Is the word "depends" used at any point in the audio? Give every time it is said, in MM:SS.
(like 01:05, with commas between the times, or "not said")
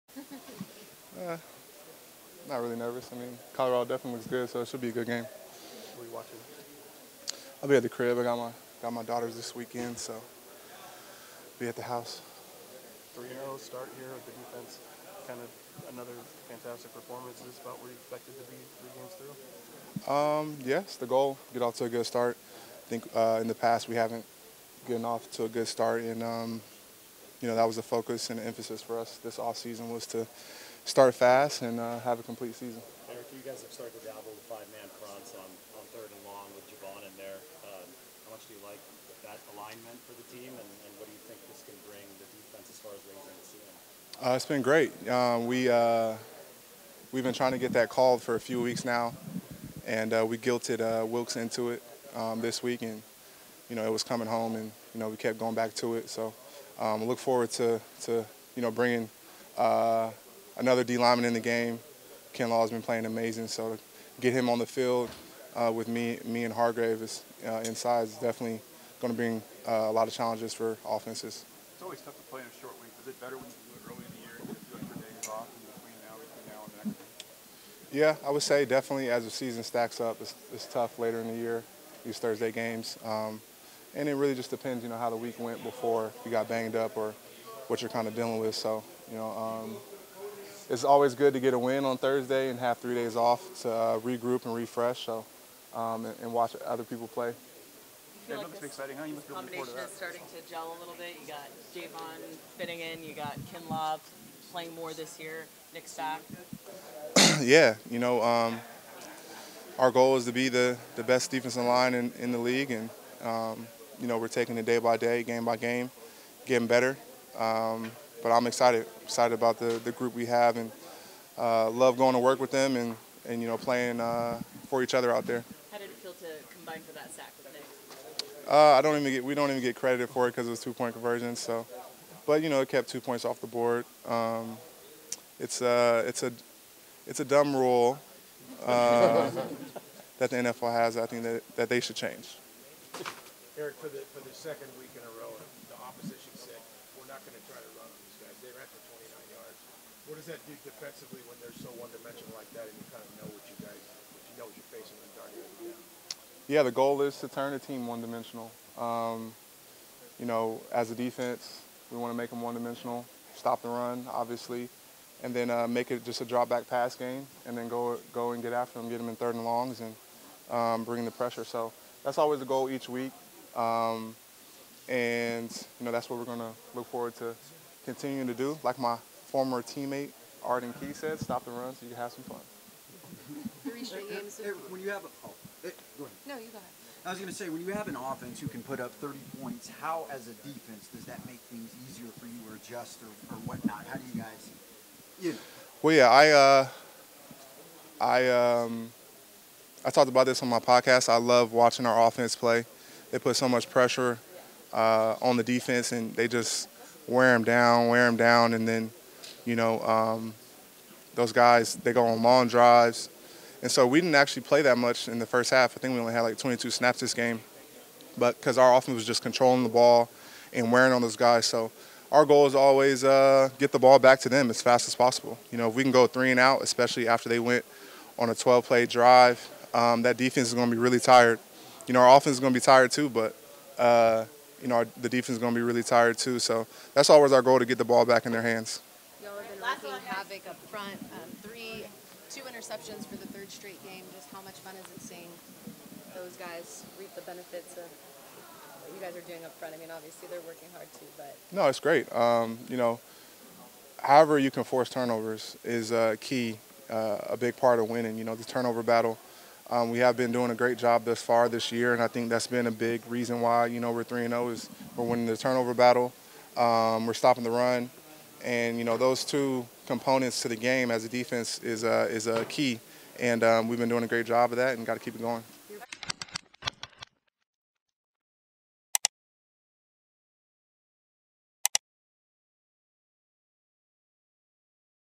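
01:24.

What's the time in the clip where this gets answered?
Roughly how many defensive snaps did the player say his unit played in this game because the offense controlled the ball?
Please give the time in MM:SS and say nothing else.
03:36.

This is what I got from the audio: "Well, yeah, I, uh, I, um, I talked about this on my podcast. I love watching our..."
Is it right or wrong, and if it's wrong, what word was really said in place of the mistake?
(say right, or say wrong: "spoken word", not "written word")
right.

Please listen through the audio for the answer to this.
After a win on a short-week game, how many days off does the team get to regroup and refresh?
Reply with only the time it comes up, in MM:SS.
01:32.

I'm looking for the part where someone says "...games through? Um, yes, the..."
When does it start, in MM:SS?
00:18.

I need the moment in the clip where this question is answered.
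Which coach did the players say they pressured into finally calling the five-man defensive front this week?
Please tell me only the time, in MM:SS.
00:51.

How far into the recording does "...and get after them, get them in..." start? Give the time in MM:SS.
02:48.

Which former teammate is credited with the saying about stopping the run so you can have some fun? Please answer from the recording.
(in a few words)
Arden Key.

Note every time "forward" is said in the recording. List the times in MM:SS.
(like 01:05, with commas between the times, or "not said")
00:57, 02:56.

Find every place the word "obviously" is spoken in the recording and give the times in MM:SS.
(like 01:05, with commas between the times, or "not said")
02:44, 04:09.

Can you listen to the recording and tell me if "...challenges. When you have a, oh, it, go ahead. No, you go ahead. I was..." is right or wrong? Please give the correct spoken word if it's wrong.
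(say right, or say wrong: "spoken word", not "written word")
wrong: "games", not "challenges".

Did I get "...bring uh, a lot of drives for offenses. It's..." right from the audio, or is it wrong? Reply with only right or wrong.
wrong.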